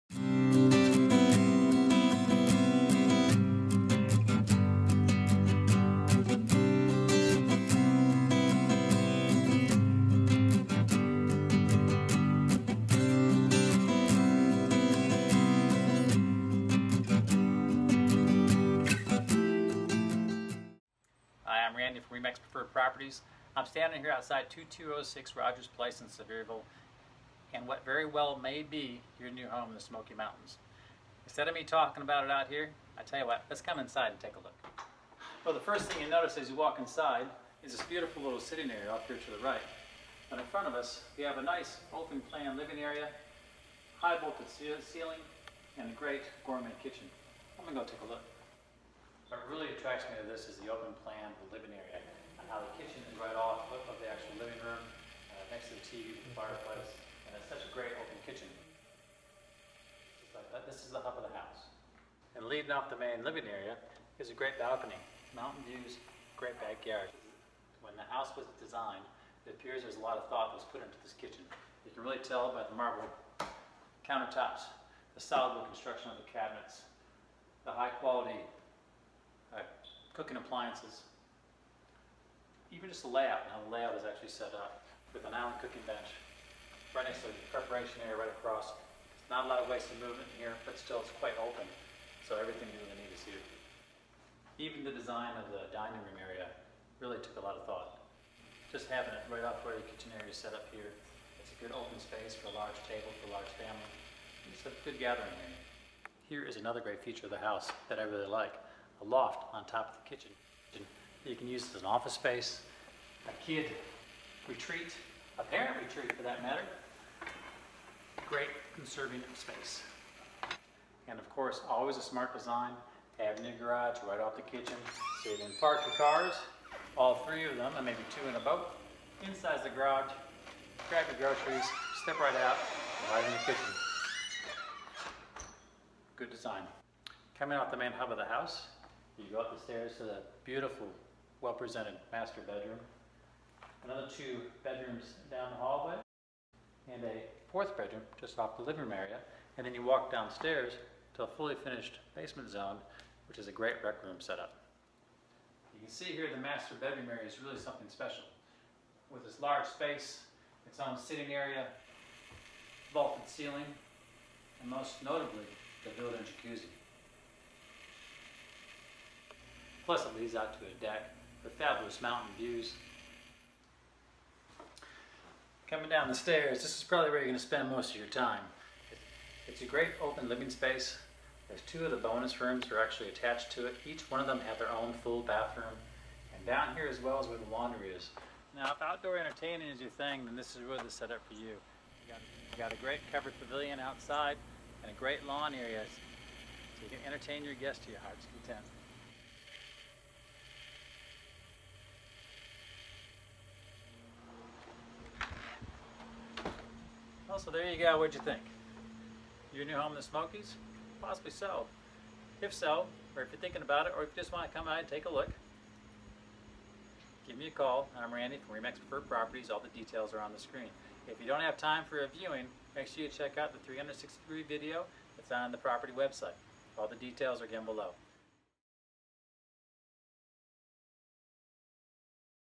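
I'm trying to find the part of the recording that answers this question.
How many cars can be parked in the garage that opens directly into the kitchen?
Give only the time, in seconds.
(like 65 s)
127 s.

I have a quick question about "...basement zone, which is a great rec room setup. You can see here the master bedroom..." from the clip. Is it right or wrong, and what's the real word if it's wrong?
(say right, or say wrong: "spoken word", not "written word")
right.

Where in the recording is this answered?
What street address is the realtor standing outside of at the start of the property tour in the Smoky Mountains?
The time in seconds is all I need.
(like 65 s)
24 s.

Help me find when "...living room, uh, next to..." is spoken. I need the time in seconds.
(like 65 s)
54 s.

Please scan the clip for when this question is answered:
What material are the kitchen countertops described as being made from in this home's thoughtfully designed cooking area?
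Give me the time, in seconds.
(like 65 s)
72 s.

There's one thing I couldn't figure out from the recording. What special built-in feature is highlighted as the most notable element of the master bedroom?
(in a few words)
jacuzzi.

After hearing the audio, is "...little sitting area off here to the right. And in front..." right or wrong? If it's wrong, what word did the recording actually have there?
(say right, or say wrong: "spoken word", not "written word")
right.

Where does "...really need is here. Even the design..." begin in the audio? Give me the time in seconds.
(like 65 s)
92 s.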